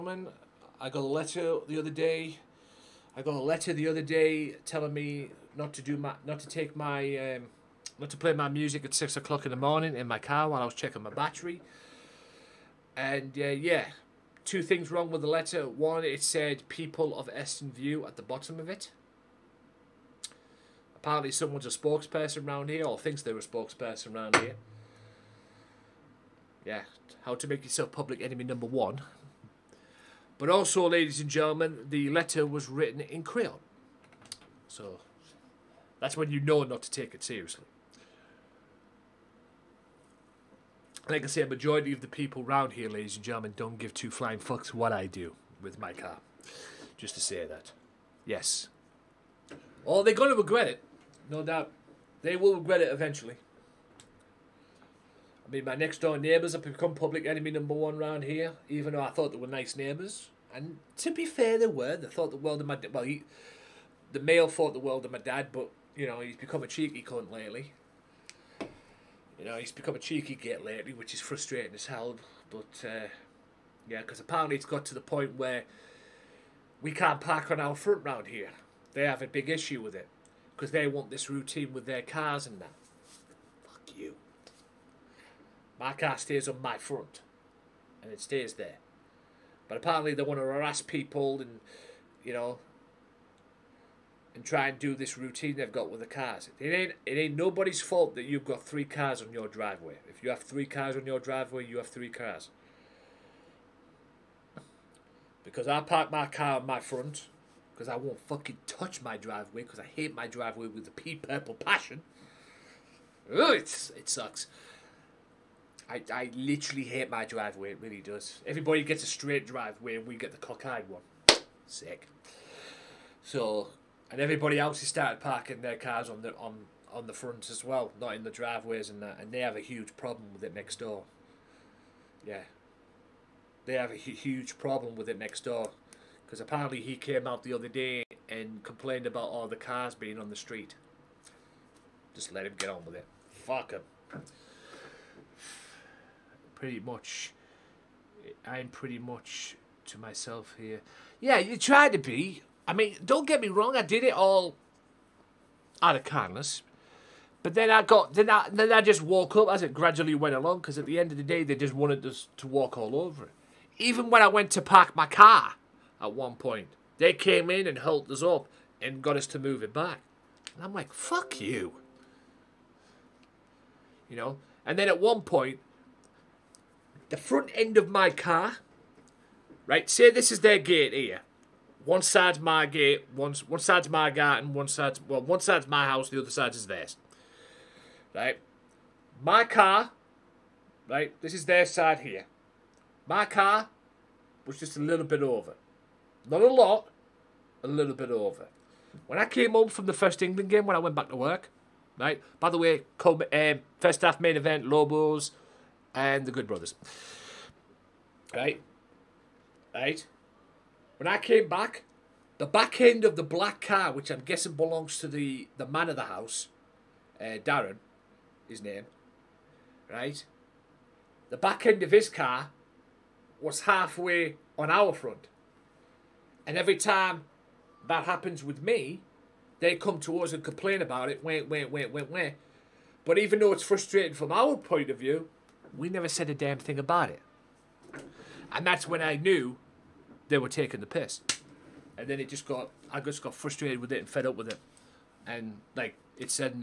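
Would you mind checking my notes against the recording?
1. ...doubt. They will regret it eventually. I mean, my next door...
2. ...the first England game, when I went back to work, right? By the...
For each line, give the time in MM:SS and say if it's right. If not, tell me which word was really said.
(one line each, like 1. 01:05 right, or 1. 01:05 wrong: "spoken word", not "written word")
1. 00:51 right
2. 03:19 right.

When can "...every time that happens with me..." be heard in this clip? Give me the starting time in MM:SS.
03:46.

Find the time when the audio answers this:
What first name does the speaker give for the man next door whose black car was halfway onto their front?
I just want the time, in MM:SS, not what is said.
03:37.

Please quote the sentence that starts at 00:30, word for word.
But also, ladies and gentlemen, the letter was written in crayon.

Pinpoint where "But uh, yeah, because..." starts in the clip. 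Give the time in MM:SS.
01:12.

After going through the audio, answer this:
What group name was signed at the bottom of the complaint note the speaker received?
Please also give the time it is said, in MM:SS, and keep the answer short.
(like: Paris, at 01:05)
People of Eston View, at 00:16.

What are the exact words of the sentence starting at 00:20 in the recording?
Apparently, someone's a spokesperson around here, or thinks they're a spokesperson around here.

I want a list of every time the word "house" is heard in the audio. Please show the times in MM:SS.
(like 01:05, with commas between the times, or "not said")
03:05, 03:36.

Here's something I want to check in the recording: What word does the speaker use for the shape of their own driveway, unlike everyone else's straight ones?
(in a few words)
Cockeyed.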